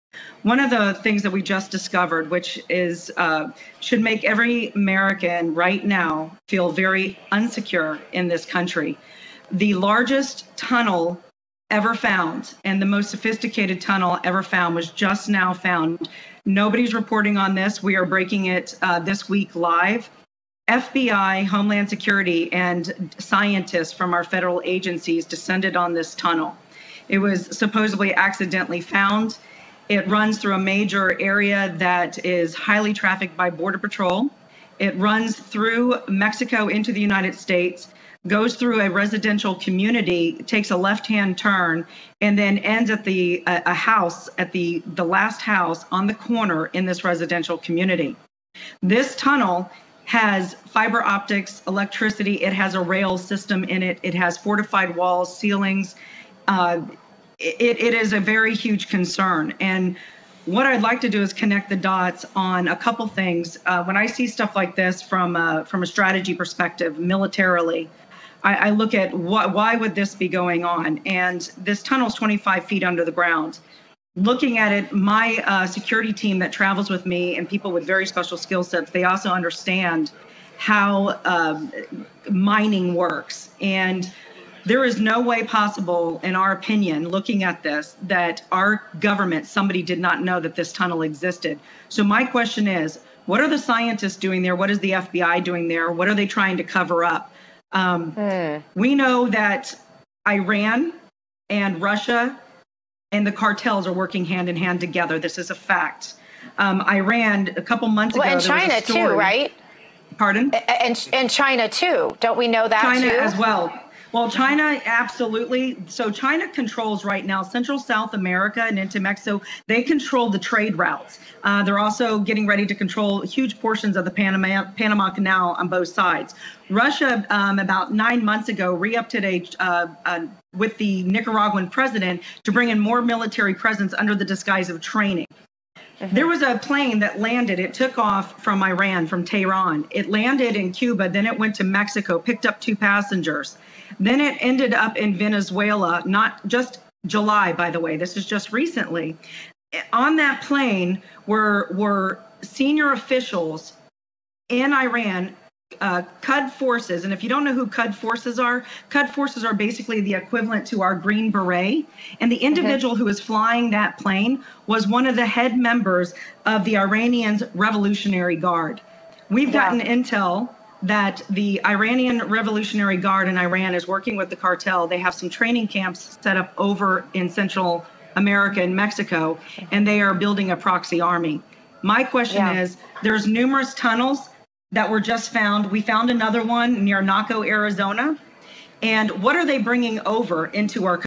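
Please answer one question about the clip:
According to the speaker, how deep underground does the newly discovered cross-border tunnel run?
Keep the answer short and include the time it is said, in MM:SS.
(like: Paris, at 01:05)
25 feet, at 01:12.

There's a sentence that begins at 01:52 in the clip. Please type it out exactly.
Don't we know that China too?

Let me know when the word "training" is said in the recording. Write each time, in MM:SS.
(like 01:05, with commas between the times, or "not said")
02:14, 02:55.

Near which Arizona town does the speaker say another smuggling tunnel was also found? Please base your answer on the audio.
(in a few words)
Naco.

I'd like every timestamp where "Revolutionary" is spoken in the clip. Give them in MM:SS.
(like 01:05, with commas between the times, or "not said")
02:47, 02:52.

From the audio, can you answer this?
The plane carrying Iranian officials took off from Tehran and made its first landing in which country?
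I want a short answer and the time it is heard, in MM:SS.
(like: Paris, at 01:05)
Cuba, at 02:20.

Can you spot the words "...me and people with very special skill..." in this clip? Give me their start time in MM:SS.
01:17.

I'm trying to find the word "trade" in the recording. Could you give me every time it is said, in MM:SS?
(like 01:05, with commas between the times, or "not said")
02:00.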